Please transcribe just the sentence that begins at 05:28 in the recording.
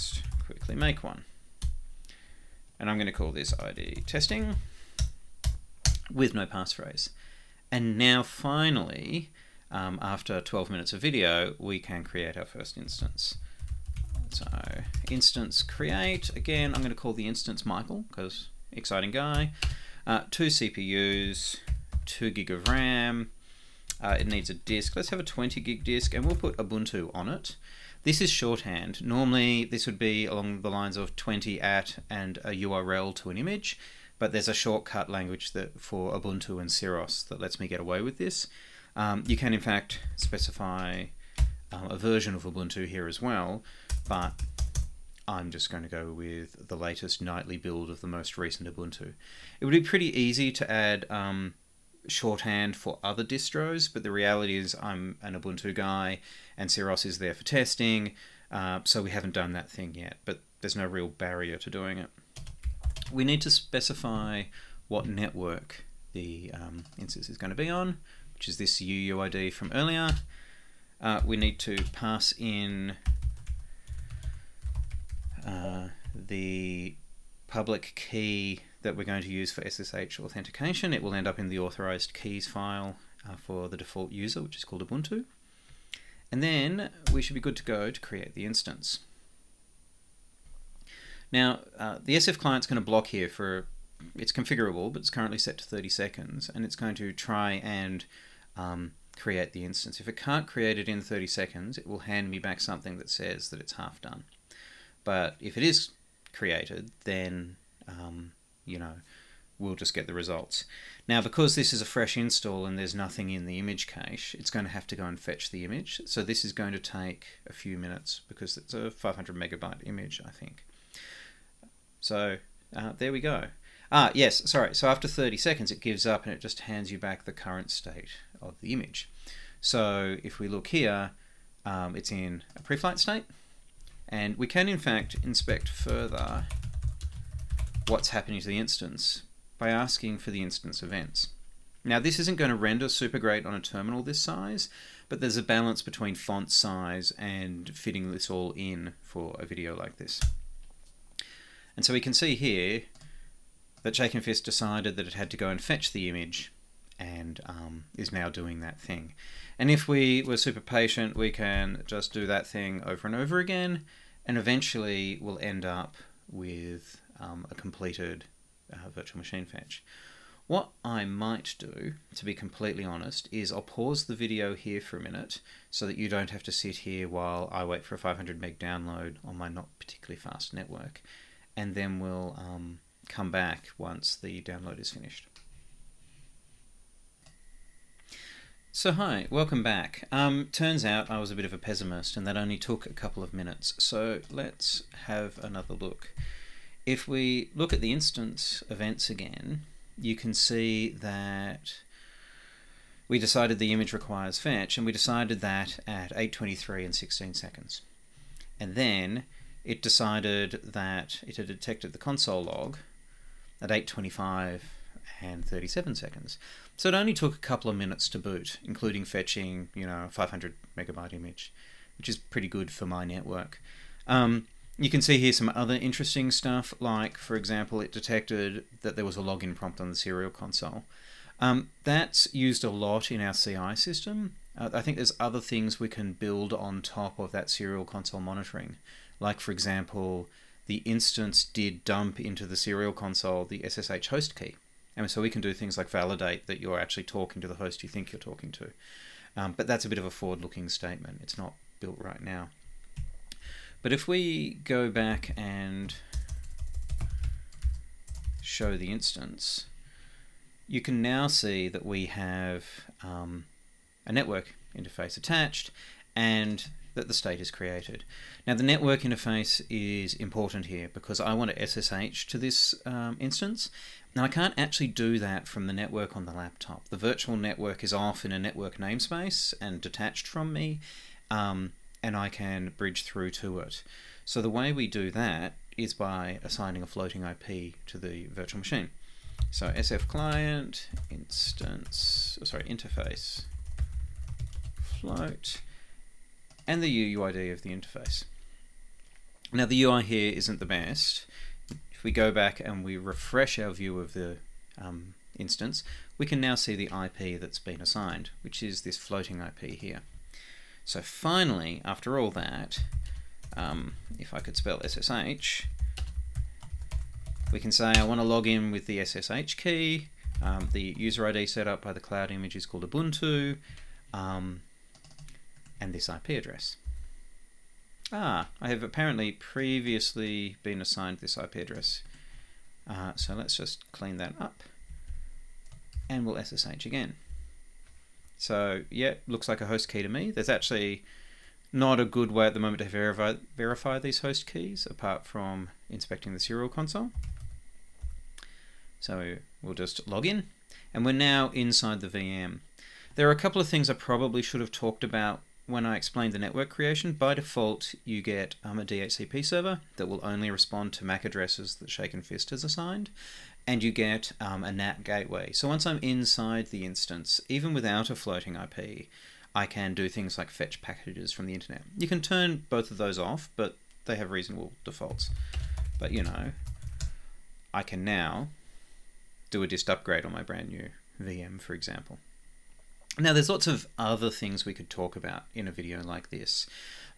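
Ah, I have apparently previously been assigned this IP address.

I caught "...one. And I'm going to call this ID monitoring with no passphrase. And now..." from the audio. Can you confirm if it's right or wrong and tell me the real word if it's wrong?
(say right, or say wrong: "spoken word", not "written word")
wrong: "testing", not "monitoring".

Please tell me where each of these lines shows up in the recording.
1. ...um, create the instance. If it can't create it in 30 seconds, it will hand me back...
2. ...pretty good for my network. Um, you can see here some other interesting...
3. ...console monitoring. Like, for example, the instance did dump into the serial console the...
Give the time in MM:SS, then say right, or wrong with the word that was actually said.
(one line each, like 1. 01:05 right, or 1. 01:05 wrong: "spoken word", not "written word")
1. 01:38 right
2. 03:42 right
3. 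03:57 right.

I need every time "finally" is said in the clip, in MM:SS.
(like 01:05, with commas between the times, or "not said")
00:08, 05:11.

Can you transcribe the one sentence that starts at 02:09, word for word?
So if we look here, um, it's in a pre-flight state.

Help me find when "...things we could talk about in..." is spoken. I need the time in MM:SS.
06:24.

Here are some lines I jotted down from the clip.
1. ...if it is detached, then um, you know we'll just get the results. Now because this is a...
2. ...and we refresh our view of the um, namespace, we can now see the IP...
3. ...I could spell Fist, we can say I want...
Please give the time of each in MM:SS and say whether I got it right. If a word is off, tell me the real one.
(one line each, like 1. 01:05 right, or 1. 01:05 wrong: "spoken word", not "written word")
1. 01:45 wrong: "created", not "detached"
2. 05:02 wrong: "instance", not "namespace"
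3. 05:14 wrong: "SSH", not "Fist".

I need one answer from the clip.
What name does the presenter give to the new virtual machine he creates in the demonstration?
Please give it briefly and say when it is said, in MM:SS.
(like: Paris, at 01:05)
Mikal, at 00:17.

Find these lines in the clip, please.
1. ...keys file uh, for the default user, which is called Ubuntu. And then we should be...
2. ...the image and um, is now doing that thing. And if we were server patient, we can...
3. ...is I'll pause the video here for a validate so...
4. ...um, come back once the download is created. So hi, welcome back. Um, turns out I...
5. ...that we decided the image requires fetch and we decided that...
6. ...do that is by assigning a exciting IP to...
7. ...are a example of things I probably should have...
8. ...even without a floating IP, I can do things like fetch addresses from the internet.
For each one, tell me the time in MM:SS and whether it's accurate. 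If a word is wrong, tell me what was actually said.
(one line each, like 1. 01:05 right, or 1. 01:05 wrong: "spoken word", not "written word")
1. 01:22 right
2. 02:35 wrong: "super", not "server"
3. 02:53 wrong: "minute", not "validate"
4. 03:02 wrong: "finished", not "created"
5. 03:20 right
6. 04:44 wrong: "floating", not "exciting"
7. 05:53 wrong: "couple", not "example"
8. 06:07 wrong: "packages", not "addresses".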